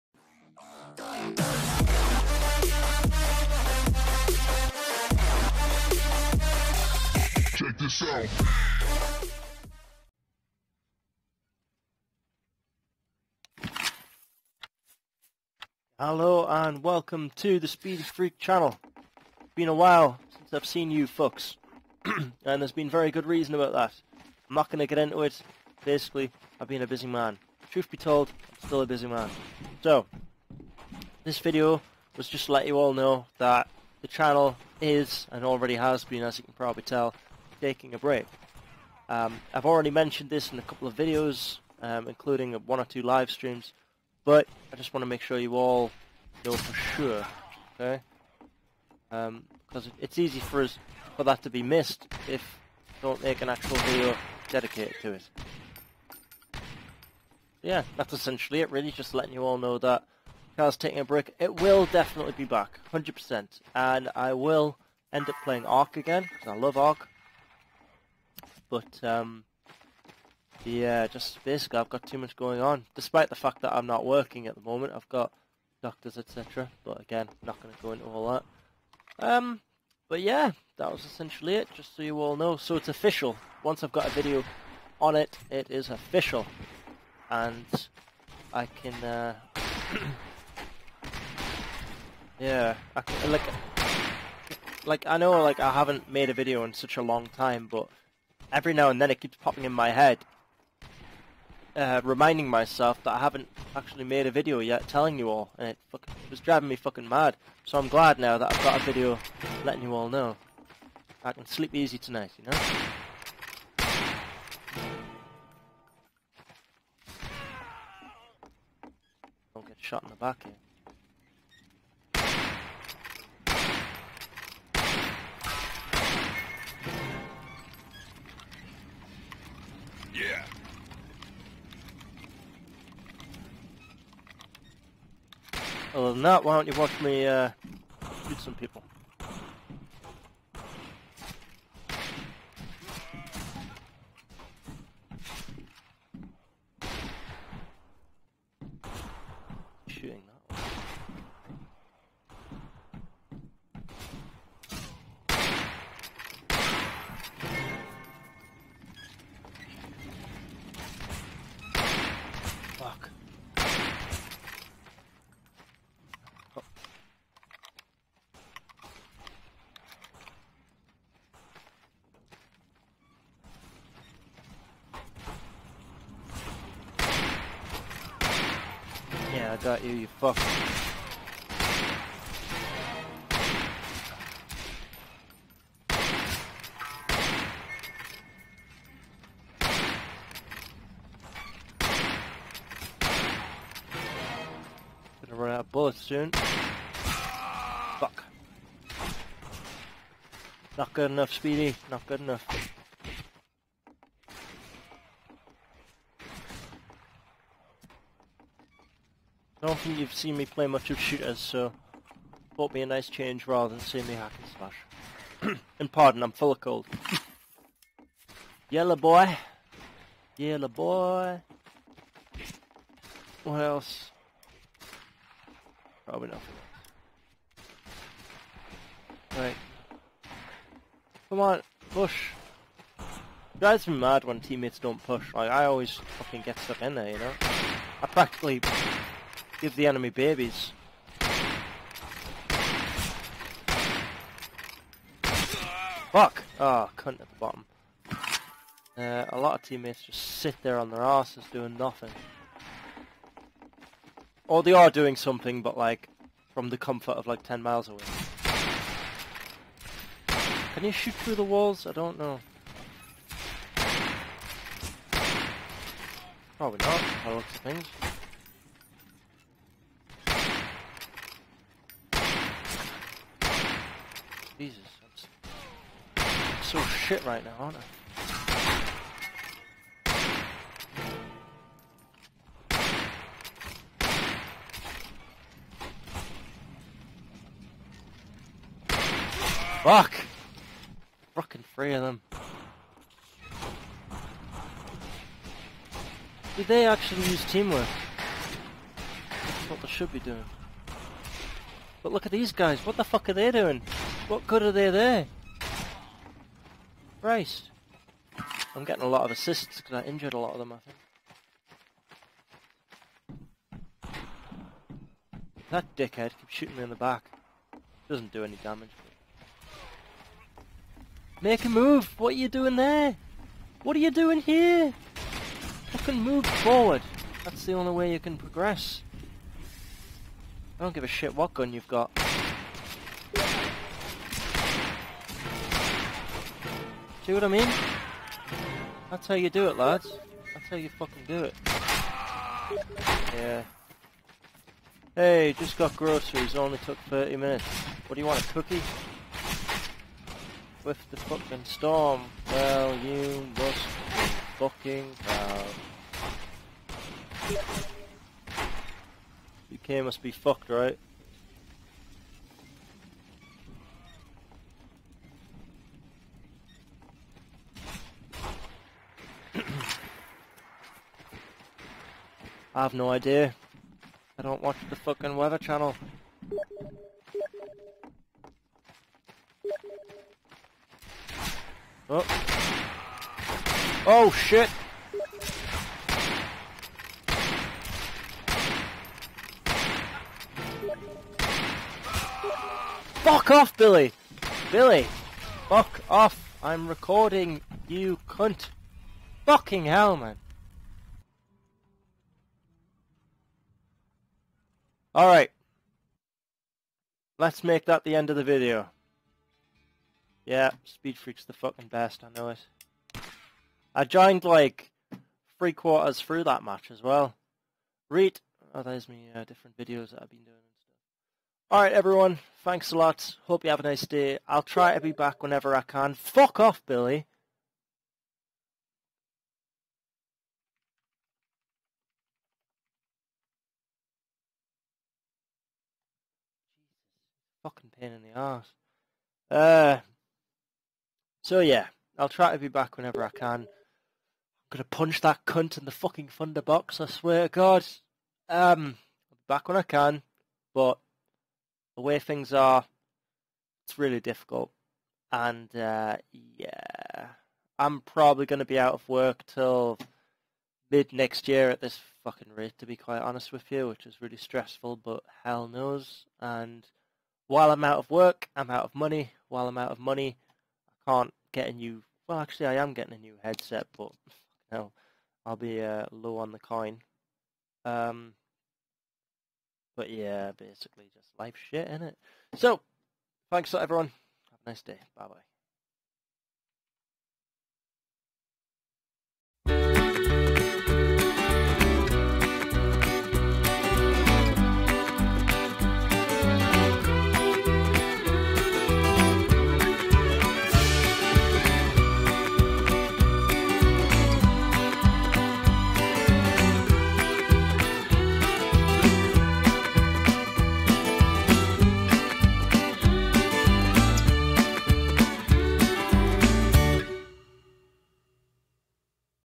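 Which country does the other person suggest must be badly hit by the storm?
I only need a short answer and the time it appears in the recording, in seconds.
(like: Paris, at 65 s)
UK, at 359 s.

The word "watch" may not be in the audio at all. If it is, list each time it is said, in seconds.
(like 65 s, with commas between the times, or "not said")
136 s, 374 s.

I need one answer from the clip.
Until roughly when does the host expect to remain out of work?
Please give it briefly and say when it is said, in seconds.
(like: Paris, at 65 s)
mid next year, at 460 s.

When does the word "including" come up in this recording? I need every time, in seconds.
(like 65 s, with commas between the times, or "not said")
42 s.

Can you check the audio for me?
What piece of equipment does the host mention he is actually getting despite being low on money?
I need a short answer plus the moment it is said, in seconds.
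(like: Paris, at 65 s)
headset, at 473 s.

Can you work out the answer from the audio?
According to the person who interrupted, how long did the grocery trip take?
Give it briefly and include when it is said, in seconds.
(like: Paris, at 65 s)
30 minutes, at 347 s.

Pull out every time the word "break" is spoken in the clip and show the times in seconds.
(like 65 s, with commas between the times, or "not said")
37 s, 61 s.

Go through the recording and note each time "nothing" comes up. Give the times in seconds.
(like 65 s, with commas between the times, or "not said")
226 s, 251 s.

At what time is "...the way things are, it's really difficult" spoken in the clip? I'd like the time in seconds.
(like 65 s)
451 s.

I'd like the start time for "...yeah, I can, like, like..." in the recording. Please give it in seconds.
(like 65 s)
92 s.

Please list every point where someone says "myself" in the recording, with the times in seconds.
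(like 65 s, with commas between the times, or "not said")
102 s.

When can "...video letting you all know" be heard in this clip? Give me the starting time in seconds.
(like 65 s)
108 s.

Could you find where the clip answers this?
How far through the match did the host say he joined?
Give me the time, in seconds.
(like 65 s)
415 s.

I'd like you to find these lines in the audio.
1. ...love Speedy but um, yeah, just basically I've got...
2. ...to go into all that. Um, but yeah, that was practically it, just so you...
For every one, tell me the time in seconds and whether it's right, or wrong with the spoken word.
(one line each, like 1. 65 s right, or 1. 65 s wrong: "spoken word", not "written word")
1. 66 s wrong: "Ark", not "Speedy"
2. 77 s wrong: "essentially", not "practically".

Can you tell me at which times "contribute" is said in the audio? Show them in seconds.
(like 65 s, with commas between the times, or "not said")
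not said.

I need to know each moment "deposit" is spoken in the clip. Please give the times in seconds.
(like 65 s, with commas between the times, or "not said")
not said.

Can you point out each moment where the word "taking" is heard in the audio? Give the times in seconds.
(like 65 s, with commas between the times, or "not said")
37 s, 60 s.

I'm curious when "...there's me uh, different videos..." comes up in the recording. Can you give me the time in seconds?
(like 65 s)
418 s.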